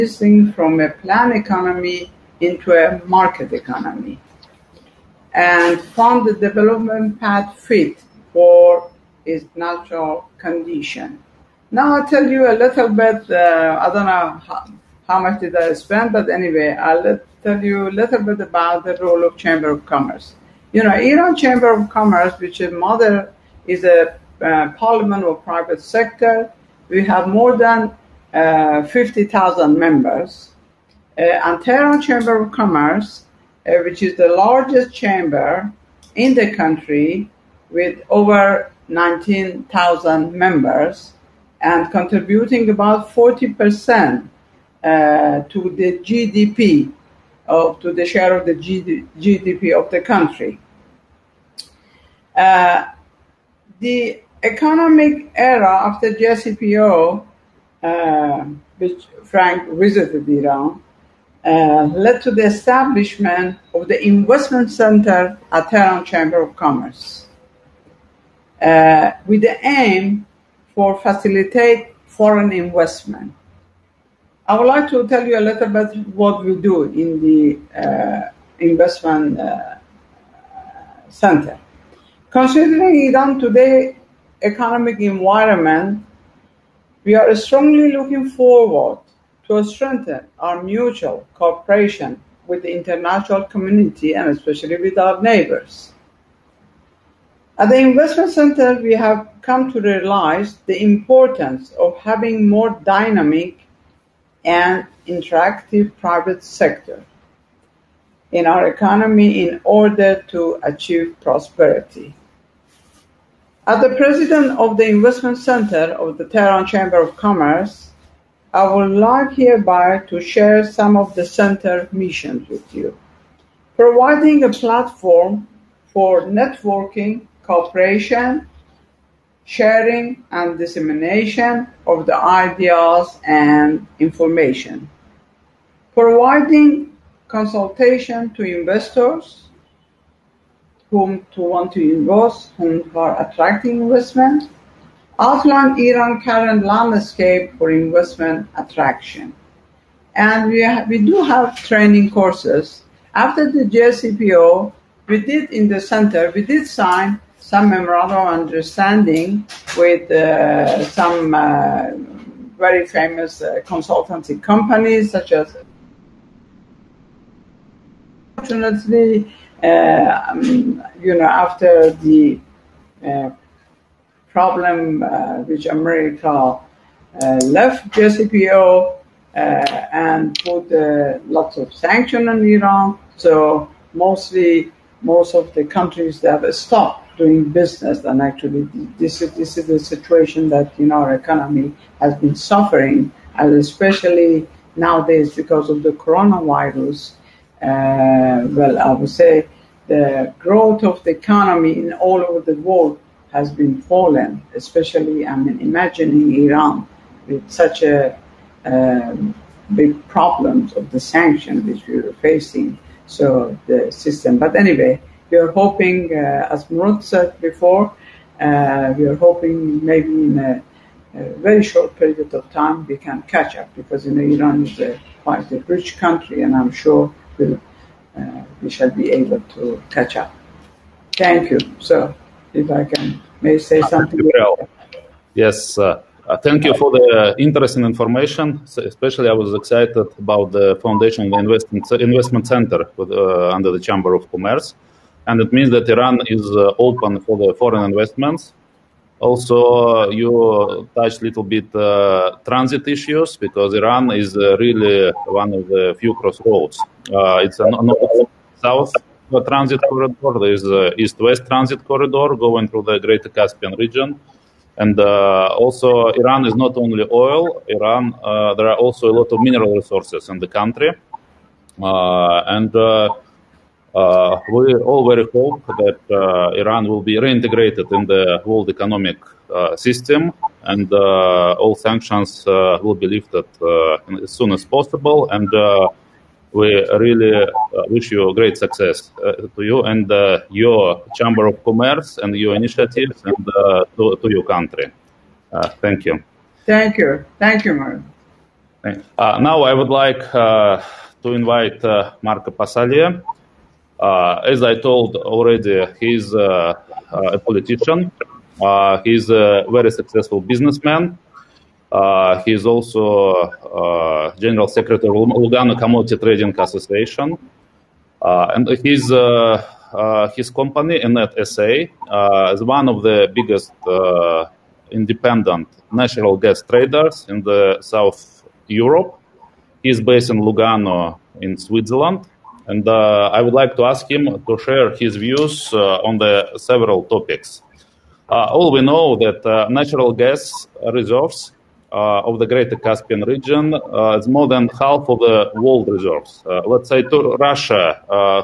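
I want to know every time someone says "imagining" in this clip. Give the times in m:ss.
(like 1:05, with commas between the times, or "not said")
3:25.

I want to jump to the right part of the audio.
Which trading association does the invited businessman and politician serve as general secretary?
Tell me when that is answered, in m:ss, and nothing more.
5:15.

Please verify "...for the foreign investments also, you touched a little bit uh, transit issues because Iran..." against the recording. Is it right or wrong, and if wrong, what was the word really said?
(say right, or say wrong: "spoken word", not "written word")
right.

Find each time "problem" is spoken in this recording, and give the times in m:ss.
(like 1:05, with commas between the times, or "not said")
2:54, 3:30.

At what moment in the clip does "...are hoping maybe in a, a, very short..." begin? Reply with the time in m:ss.
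3:39.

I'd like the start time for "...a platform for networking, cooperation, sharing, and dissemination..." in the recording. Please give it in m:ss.
2:04.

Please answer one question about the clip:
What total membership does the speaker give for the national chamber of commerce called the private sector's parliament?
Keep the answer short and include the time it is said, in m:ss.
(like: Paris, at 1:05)
more than 50,000, at 0:27.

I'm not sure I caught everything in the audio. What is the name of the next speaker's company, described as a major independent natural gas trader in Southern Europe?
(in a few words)
Enet SA.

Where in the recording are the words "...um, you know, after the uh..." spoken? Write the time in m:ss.
2:50.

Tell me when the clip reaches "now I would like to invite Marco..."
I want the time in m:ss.
4:59.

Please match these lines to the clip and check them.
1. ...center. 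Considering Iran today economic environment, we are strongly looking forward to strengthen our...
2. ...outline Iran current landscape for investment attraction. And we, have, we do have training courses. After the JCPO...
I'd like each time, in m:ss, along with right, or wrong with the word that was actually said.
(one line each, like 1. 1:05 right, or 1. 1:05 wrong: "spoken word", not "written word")
1. 1:21 right
2. 2:25 right.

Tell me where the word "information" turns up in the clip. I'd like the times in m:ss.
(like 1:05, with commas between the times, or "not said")
2:14, 3:57.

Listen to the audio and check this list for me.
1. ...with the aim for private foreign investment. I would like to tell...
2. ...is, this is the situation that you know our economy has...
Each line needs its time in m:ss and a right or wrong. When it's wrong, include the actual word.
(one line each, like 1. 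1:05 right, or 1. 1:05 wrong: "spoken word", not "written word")
1. 1:09 wrong: "facilitate", not "private"
2. 3:09 right.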